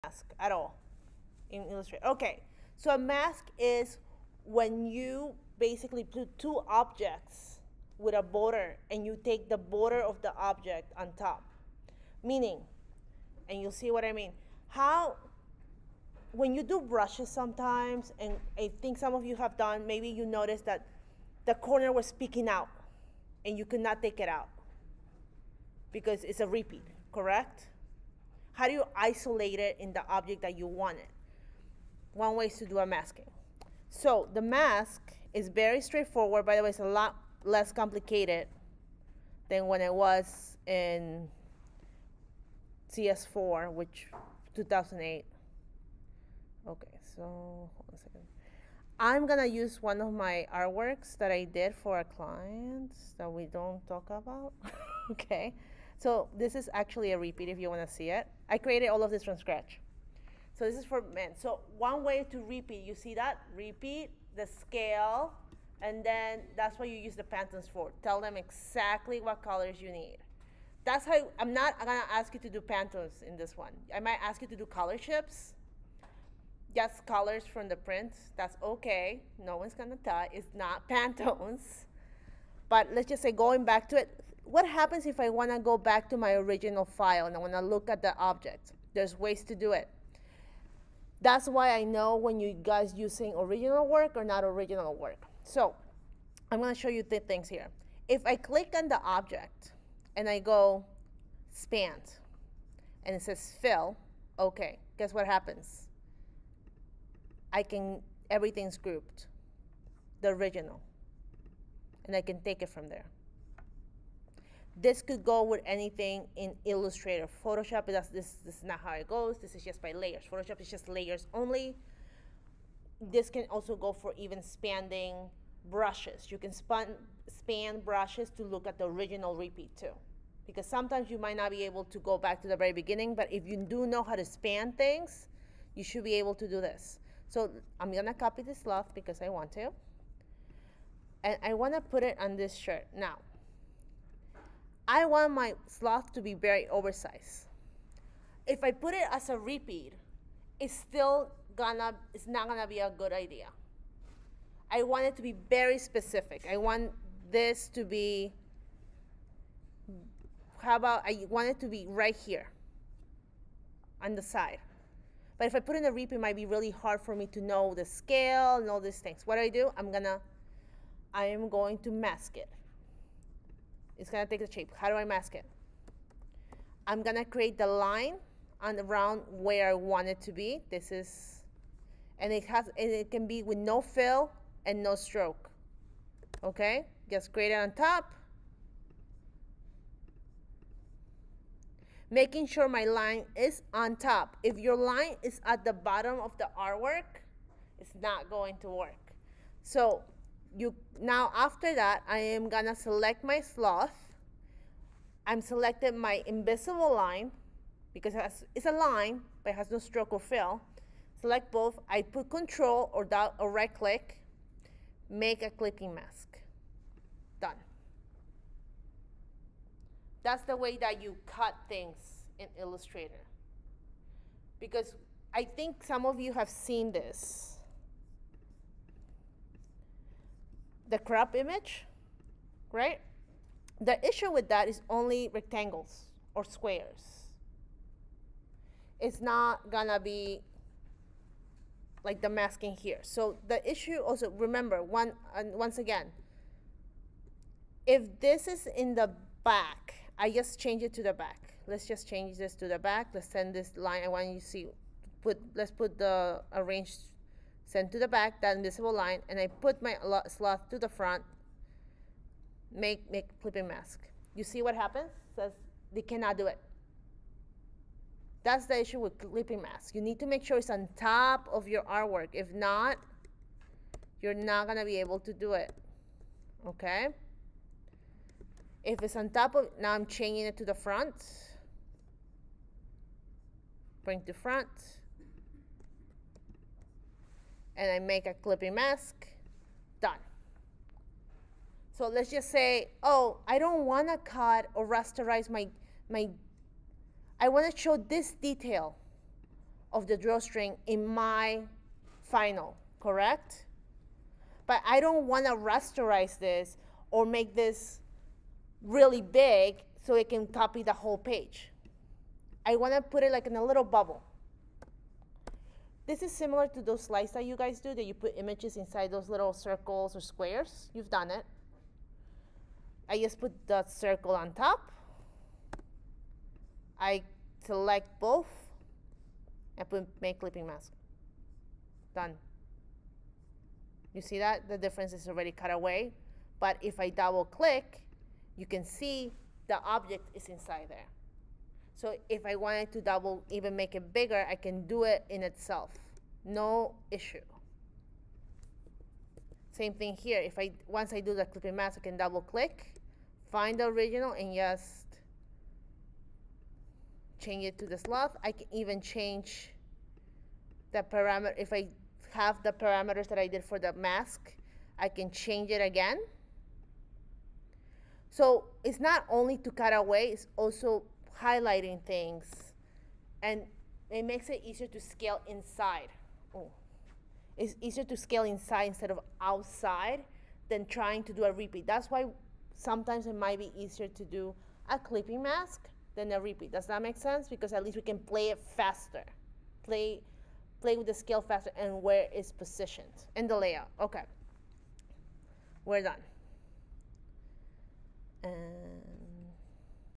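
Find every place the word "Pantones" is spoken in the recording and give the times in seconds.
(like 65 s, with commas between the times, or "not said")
67 s, 72 s, 80 s.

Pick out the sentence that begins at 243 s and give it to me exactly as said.
So the issue also, remember, one, and once again, if this is in the back, I just change it to the back.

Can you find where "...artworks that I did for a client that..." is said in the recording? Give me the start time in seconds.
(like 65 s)
50 s.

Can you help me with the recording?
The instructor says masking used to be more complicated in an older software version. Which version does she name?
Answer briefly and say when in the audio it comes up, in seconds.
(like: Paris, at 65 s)
CS4, at 42 s.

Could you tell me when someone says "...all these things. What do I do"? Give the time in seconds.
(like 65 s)
168 s.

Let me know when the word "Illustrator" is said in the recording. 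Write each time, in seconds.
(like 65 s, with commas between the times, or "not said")
1 s, 116 s, 222 s.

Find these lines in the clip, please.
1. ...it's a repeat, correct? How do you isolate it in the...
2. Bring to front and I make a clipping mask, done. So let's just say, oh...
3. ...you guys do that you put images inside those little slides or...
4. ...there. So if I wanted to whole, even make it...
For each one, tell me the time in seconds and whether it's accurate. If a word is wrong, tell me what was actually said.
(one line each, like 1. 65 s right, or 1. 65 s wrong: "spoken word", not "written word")
1. 26 s right
2. 284 s right
3. 317 s wrong: "circles", not "slides"
4. 340 s wrong: "double", not "whole".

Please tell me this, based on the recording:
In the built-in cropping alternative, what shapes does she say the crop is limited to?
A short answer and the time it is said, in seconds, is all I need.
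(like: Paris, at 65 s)
rectangles or squares, at 235 s.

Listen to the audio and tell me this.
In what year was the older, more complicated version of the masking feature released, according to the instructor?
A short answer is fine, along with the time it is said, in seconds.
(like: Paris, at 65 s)
2008, at 44 s.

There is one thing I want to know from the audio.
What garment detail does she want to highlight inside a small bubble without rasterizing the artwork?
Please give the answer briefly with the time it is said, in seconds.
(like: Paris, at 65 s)
drawstring, at 300 s.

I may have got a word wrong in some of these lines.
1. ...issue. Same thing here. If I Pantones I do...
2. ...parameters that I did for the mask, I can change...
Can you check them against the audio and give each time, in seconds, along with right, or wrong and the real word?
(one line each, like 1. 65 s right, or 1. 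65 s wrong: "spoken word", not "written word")
1. 347 s wrong: "Once", not "Pantones"
2. 362 s right.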